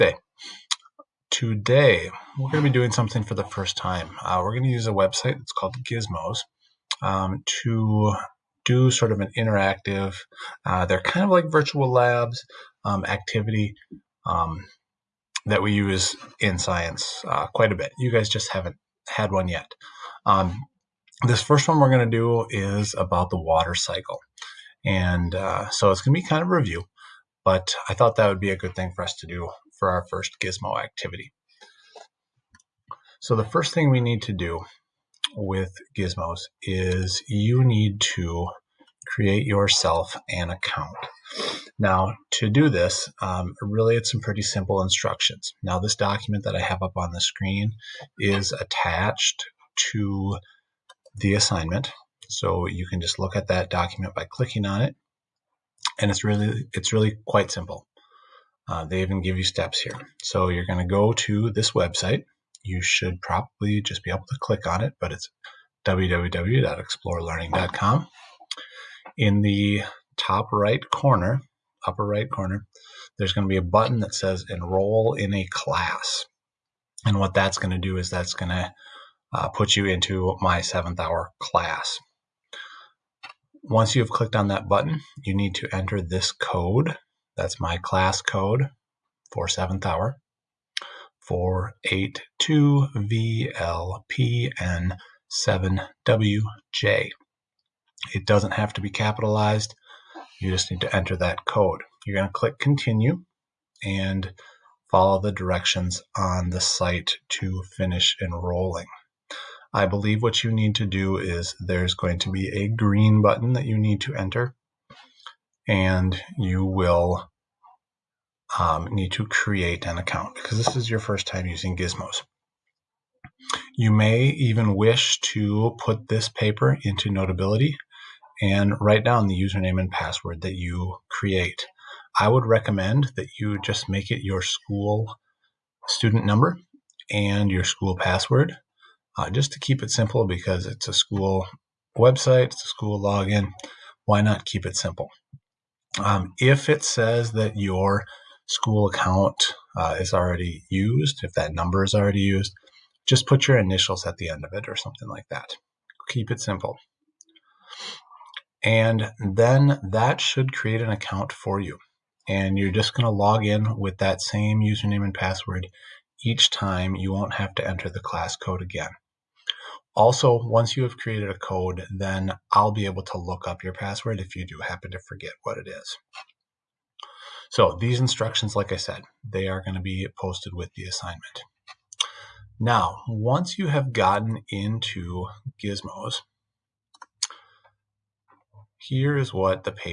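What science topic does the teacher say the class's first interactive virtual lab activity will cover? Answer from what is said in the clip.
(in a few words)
The water cycle.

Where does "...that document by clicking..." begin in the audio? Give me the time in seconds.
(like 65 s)
53 s.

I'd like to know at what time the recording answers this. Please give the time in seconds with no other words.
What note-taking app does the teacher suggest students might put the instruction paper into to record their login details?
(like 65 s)
127 s.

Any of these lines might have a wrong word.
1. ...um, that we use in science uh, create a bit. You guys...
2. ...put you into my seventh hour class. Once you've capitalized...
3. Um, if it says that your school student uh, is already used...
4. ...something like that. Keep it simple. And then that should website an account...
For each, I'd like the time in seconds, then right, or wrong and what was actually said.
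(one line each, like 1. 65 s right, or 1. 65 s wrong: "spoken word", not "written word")
1. 14 s wrong: "quite", not "create"
2. 79 s wrong: "clicked", not "capitalized"
3. 146 s wrong: "account", not "student"
4. 154 s wrong: "create", not "website".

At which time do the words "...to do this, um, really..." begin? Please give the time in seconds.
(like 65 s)
42 s.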